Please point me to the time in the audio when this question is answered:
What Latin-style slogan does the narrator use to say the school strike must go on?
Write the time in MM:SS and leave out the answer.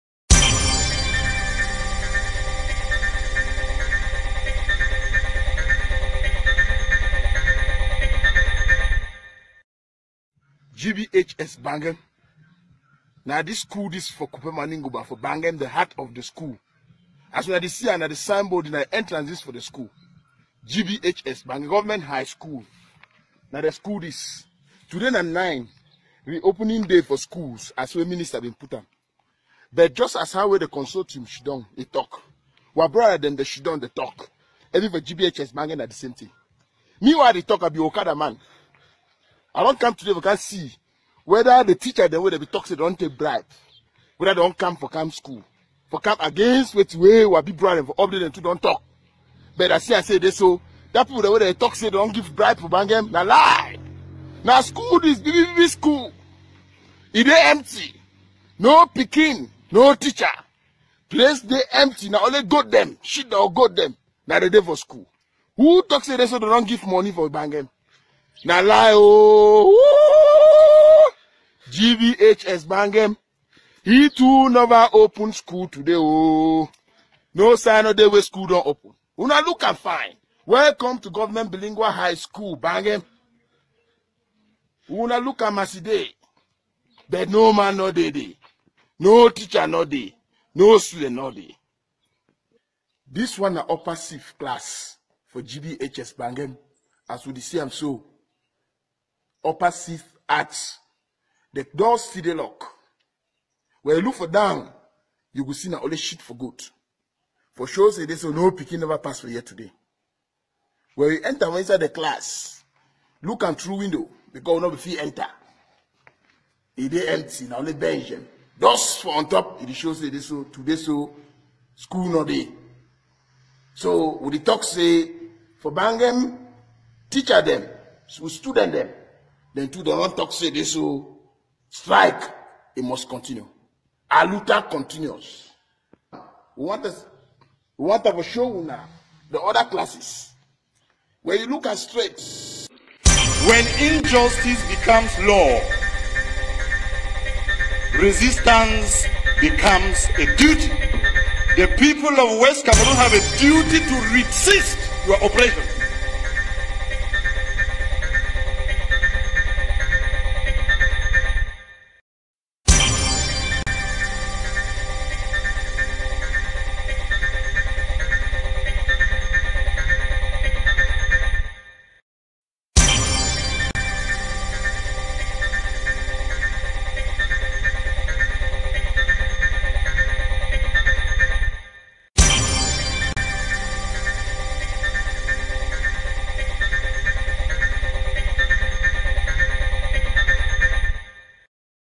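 02:14.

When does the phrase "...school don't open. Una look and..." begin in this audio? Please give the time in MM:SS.
01:18.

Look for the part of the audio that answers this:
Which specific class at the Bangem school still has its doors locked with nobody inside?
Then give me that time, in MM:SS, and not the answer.
01:39.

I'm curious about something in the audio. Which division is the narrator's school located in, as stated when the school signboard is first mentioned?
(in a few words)
Kupe-Manenguba.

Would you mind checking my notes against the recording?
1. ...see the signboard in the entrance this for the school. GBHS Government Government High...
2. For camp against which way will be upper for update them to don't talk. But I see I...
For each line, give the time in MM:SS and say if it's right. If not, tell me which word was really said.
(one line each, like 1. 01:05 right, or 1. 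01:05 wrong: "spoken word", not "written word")
1. 00:17 wrong: "Bangem", not "Government"
2. 00:45 wrong: "brother", not "upper".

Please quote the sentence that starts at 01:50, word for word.
When you enter inside the class, look and through window because no fee enter.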